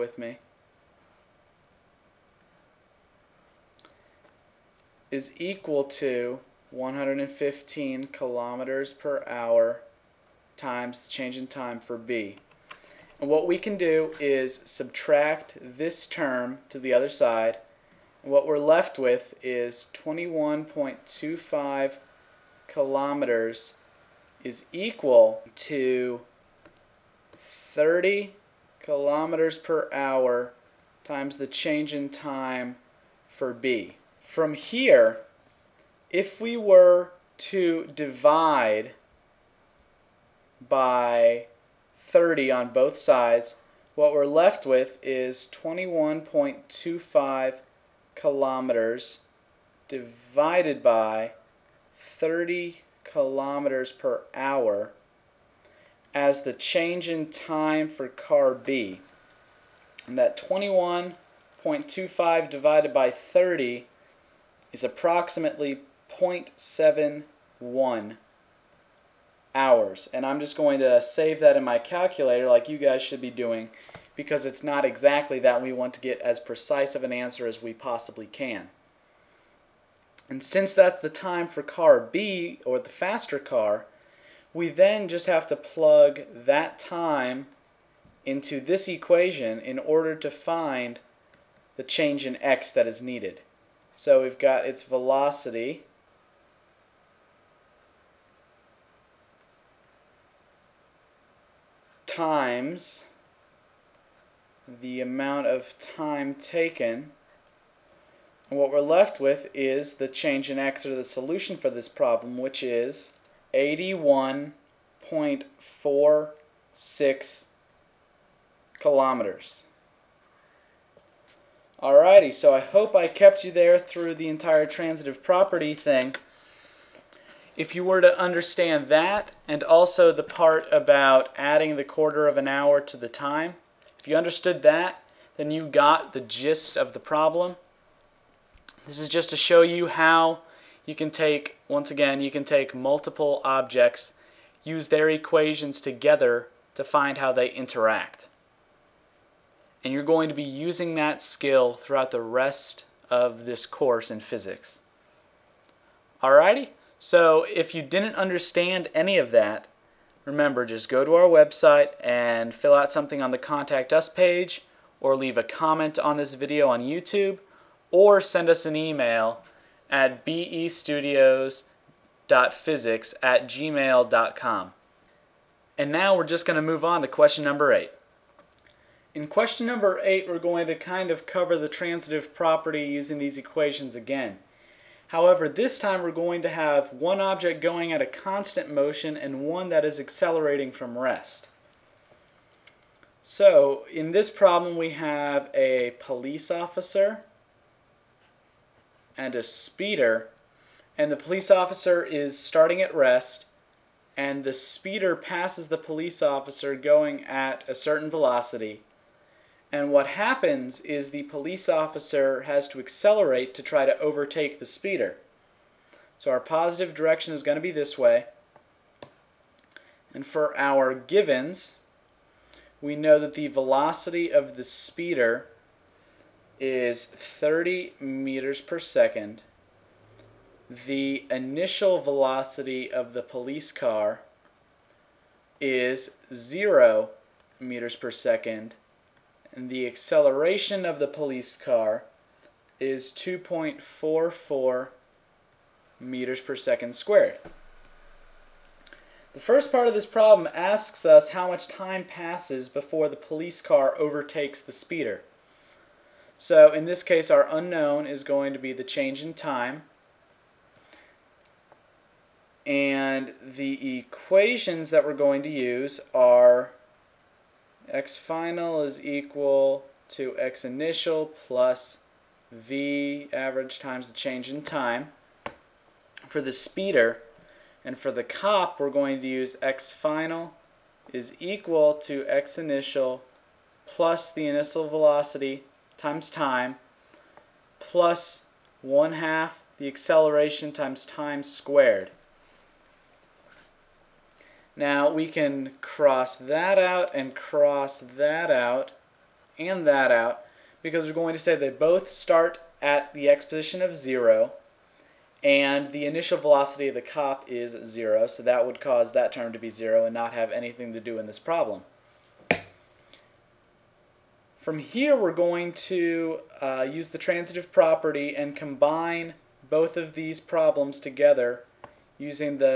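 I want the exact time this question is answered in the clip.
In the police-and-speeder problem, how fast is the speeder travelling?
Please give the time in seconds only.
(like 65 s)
227 s.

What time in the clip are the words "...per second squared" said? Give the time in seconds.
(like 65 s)
246 s.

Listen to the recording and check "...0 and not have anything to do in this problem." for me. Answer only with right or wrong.
right.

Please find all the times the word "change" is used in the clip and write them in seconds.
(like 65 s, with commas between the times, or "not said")
11 s, 31 s, 56 s, 91 s, 110 s, 258 s, 274 s.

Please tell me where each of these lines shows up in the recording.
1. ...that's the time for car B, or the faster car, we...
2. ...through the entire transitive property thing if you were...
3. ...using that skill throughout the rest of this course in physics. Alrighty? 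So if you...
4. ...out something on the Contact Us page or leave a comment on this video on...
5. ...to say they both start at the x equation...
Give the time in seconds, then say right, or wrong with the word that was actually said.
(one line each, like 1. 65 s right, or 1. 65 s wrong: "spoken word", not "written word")
1. 80 s right
2. 123 s right
3. 150 s right
4. 162 s right
5. 301 s wrong: "position", not "equation".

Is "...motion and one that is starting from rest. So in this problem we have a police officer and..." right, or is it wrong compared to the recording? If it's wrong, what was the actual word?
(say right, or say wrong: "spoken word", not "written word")
wrong: "accelerating", not "starting".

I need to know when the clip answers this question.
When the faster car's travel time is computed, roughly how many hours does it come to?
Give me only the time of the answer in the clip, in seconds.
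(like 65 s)
66 s.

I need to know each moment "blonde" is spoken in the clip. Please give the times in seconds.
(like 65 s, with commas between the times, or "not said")
not said.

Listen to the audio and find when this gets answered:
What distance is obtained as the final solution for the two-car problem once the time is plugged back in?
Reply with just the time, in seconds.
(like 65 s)
113 s.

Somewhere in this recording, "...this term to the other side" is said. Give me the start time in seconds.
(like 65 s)
15 s.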